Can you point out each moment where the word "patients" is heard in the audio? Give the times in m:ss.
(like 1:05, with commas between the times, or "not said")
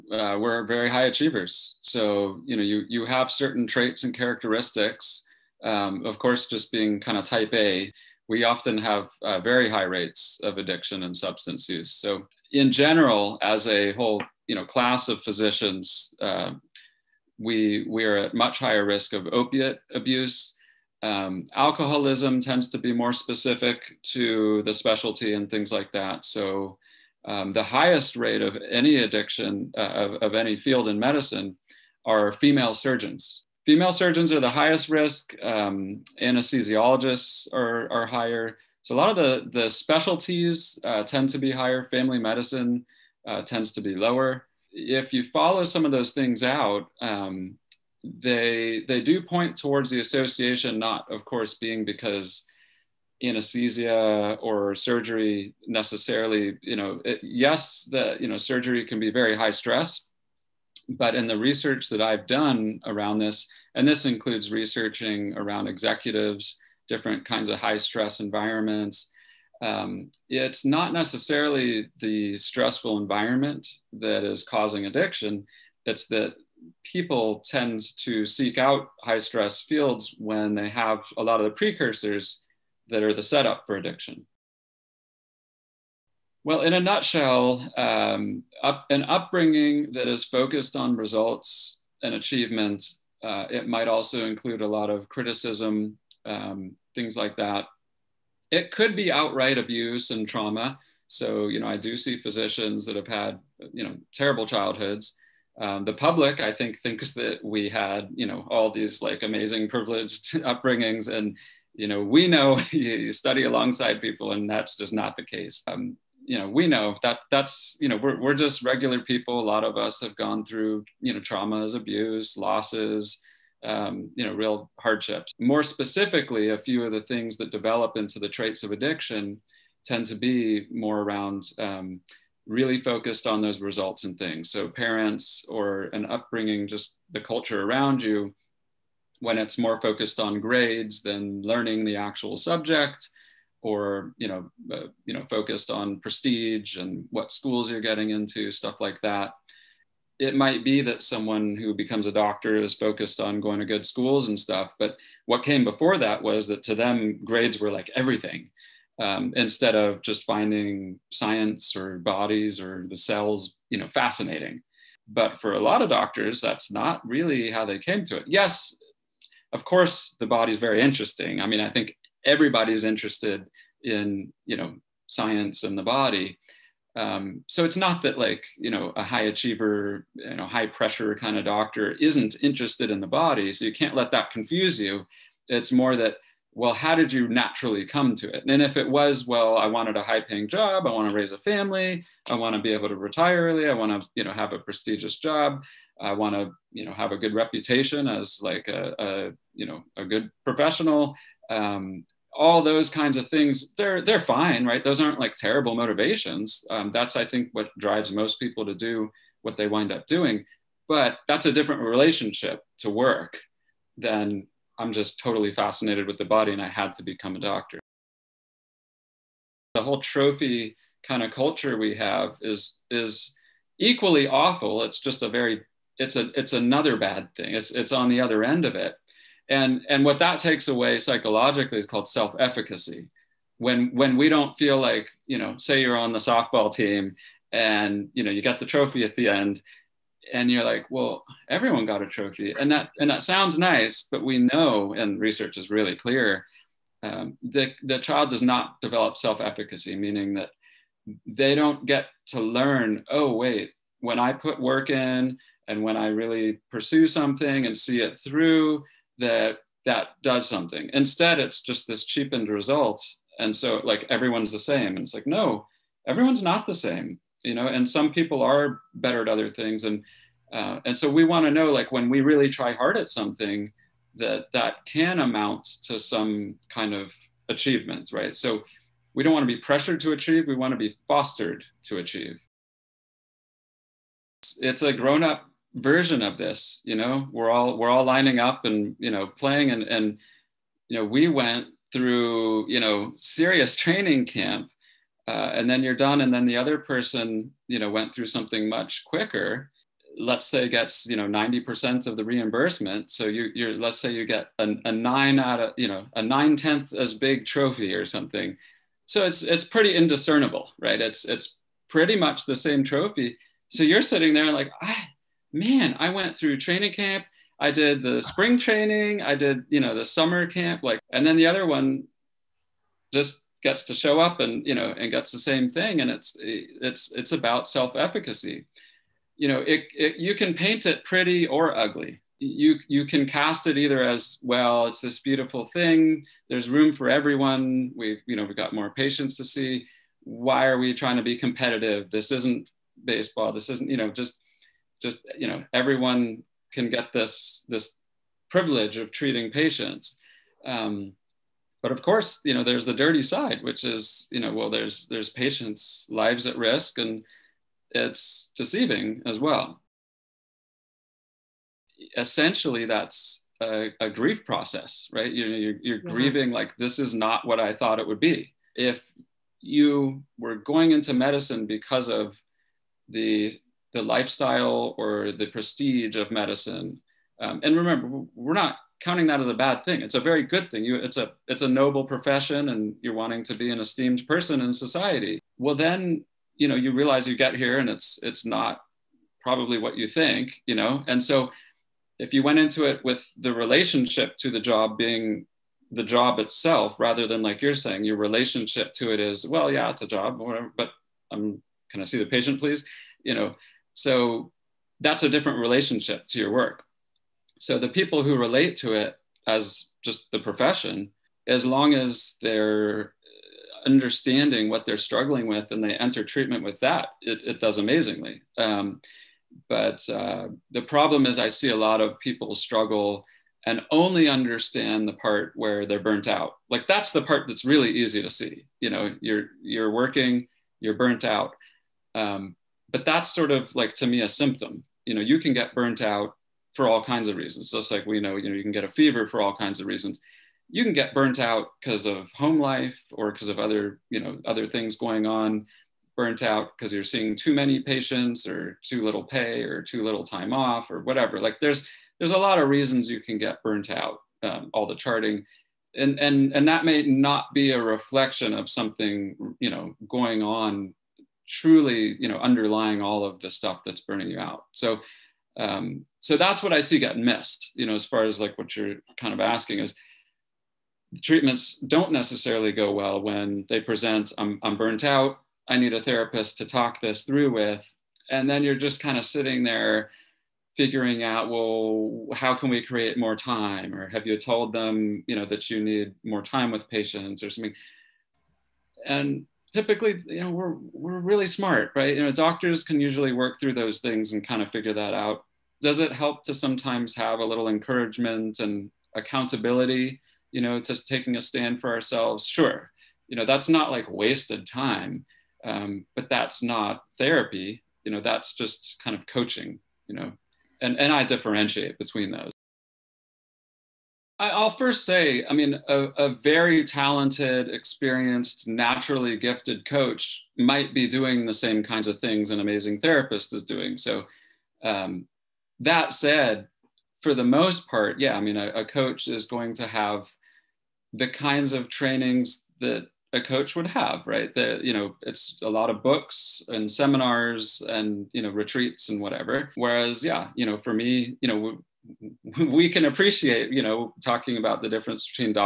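5:38, 5:49, 5:55, 6:42, 7:27, 8:06.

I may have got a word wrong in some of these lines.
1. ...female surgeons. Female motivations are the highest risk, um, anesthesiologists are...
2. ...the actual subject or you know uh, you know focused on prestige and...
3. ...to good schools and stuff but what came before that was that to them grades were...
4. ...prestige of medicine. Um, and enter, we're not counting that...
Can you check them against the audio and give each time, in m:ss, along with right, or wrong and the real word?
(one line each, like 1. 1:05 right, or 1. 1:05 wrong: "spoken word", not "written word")
1. 0:32 wrong: "surgeons", not "motivations"
2. 2:21 right
3. 2:33 right
4. 6:15 wrong: "remember", not "enter".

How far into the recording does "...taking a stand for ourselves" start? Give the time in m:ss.
8:21.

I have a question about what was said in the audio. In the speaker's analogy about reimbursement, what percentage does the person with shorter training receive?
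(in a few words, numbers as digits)
90%.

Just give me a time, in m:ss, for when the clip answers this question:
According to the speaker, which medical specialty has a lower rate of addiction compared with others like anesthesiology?
0:41.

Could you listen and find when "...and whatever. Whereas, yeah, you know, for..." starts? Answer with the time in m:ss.
8:59.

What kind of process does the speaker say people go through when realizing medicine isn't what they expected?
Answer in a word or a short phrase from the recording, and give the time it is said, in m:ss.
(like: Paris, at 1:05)
Grief process, at 6:04.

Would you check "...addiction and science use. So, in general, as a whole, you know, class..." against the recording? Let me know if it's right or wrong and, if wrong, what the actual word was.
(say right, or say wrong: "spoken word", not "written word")
wrong: "substance", not "science".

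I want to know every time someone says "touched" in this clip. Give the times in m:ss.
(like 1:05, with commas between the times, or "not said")
not said.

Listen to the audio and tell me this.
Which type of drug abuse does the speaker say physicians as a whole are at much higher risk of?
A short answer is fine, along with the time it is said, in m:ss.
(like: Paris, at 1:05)
Opiate abuse, at 0:19.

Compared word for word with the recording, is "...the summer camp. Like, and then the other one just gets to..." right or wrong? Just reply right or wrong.
right.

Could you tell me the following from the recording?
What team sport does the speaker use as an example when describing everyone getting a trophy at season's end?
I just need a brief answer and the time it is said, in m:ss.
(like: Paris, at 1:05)
Softball, at 3:56.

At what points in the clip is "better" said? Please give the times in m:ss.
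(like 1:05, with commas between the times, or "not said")
4:28.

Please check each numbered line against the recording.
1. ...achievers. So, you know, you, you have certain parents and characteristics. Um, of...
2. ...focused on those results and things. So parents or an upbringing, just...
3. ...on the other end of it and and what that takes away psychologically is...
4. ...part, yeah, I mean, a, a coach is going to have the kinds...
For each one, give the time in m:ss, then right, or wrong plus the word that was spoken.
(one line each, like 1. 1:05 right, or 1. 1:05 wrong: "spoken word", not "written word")
1. 0:01 wrong: "traits", not "parents"
2. 2:12 right
3. 3:47 right
4. 8:47 right.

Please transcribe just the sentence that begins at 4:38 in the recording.
So we don't want to be pressured to achieve, we want to be fostered to achieve.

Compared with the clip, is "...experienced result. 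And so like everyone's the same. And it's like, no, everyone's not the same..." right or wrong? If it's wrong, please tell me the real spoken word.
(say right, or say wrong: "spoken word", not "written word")
wrong: "cheapened", not "experienced".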